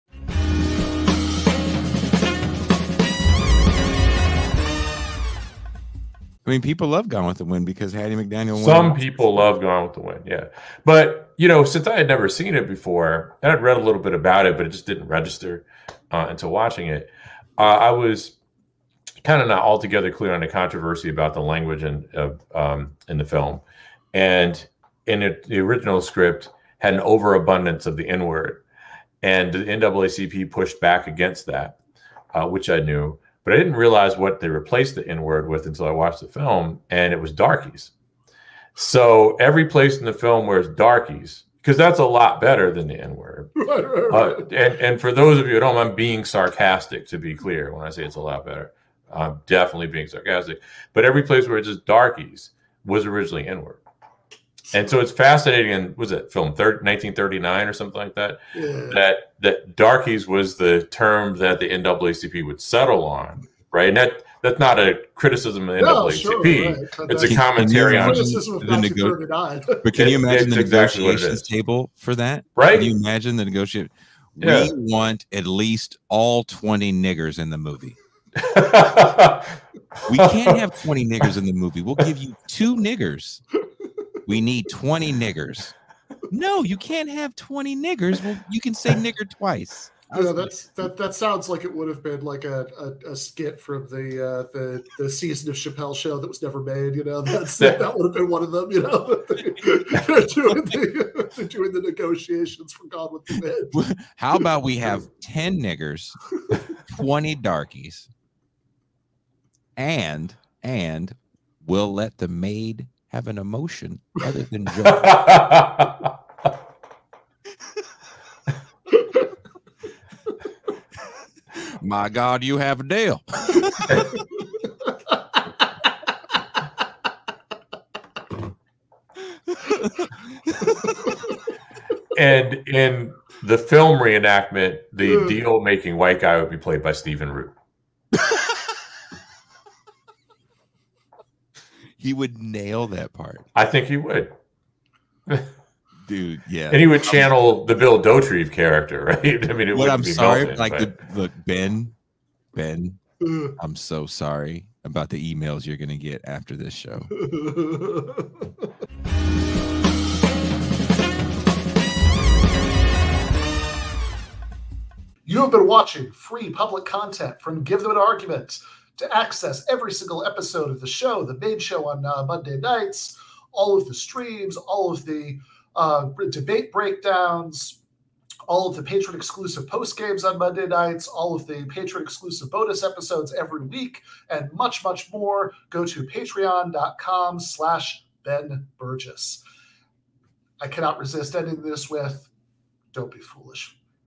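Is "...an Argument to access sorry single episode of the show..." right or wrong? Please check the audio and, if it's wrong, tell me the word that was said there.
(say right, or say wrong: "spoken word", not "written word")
wrong: "every", not "sorry".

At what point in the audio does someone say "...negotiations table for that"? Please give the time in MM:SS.
01:10.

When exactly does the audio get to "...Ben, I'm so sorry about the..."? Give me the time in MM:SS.
02:32.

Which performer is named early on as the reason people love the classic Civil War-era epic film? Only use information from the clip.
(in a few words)
Hattie McDaniel.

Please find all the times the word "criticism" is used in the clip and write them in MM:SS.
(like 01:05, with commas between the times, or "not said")
01:05.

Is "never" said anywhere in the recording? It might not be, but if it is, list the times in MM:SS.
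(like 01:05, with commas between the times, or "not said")
00:12, 01:36.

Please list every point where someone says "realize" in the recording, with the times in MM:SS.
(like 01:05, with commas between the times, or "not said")
00:33.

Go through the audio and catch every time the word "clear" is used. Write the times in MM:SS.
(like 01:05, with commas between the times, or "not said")
00:20, 00:47.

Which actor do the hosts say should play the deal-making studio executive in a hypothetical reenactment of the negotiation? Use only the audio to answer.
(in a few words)
Stephen Root.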